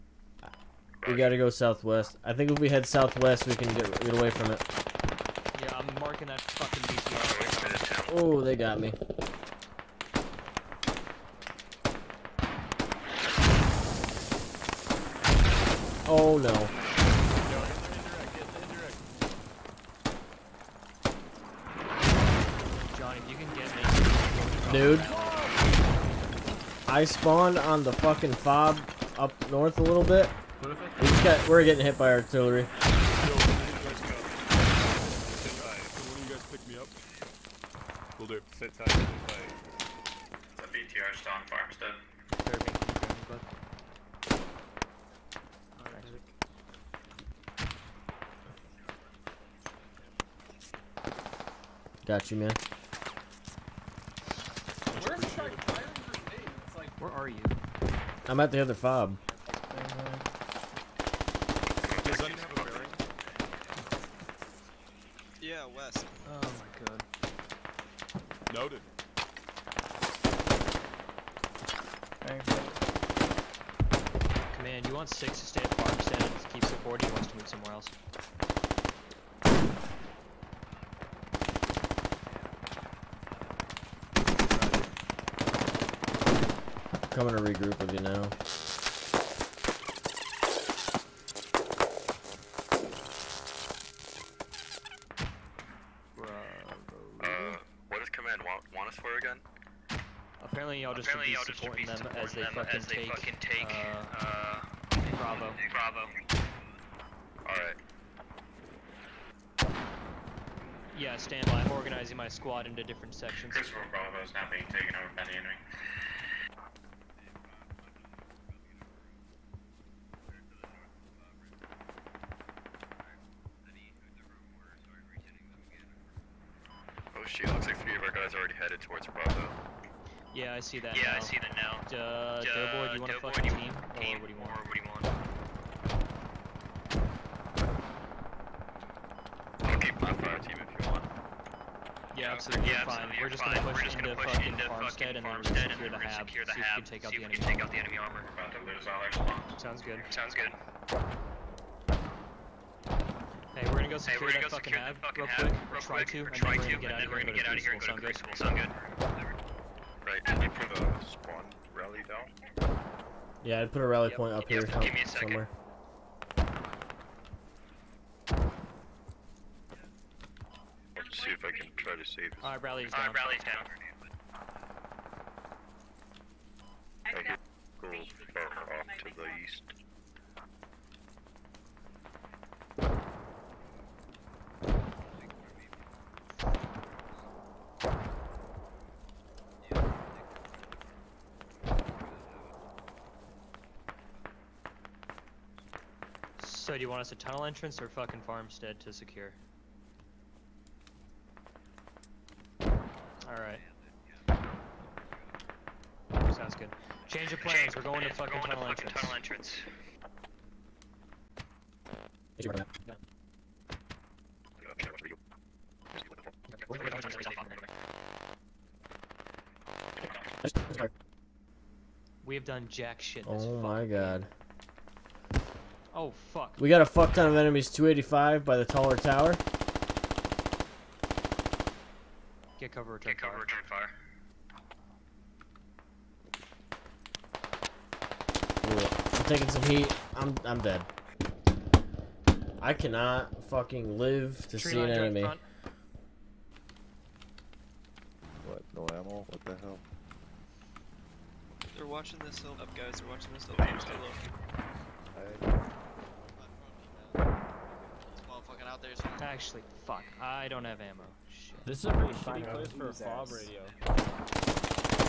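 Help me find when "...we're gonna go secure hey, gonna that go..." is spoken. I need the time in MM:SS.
02:33.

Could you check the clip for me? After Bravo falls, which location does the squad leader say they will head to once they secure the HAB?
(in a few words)
Crucible.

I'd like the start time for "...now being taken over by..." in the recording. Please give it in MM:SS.
01:54.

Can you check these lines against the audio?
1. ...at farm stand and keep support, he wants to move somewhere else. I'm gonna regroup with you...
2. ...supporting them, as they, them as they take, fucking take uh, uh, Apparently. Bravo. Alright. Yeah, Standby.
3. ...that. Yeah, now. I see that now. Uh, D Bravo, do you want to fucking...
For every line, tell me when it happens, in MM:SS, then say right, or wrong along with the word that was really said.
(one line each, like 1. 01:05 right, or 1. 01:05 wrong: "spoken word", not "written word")
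1. 01:15 right
2. 01:41 wrong: "Bravo", not "Apparently"
3. 02:10 wrong: "Doughboy", not "Bravo".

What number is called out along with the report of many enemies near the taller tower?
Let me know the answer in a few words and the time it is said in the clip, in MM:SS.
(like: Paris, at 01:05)
285, at 03:47.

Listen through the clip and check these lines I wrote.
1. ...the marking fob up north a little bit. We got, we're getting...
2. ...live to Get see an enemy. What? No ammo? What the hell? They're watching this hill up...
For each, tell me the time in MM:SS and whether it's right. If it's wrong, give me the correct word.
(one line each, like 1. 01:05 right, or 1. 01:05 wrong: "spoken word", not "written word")
1. 00:27 wrong: "fucking", not "marking"
2. 04:03 wrong: "Tree", not "Get".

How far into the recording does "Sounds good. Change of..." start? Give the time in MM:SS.
03:26.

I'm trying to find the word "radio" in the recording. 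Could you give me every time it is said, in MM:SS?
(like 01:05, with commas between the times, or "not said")
04:23.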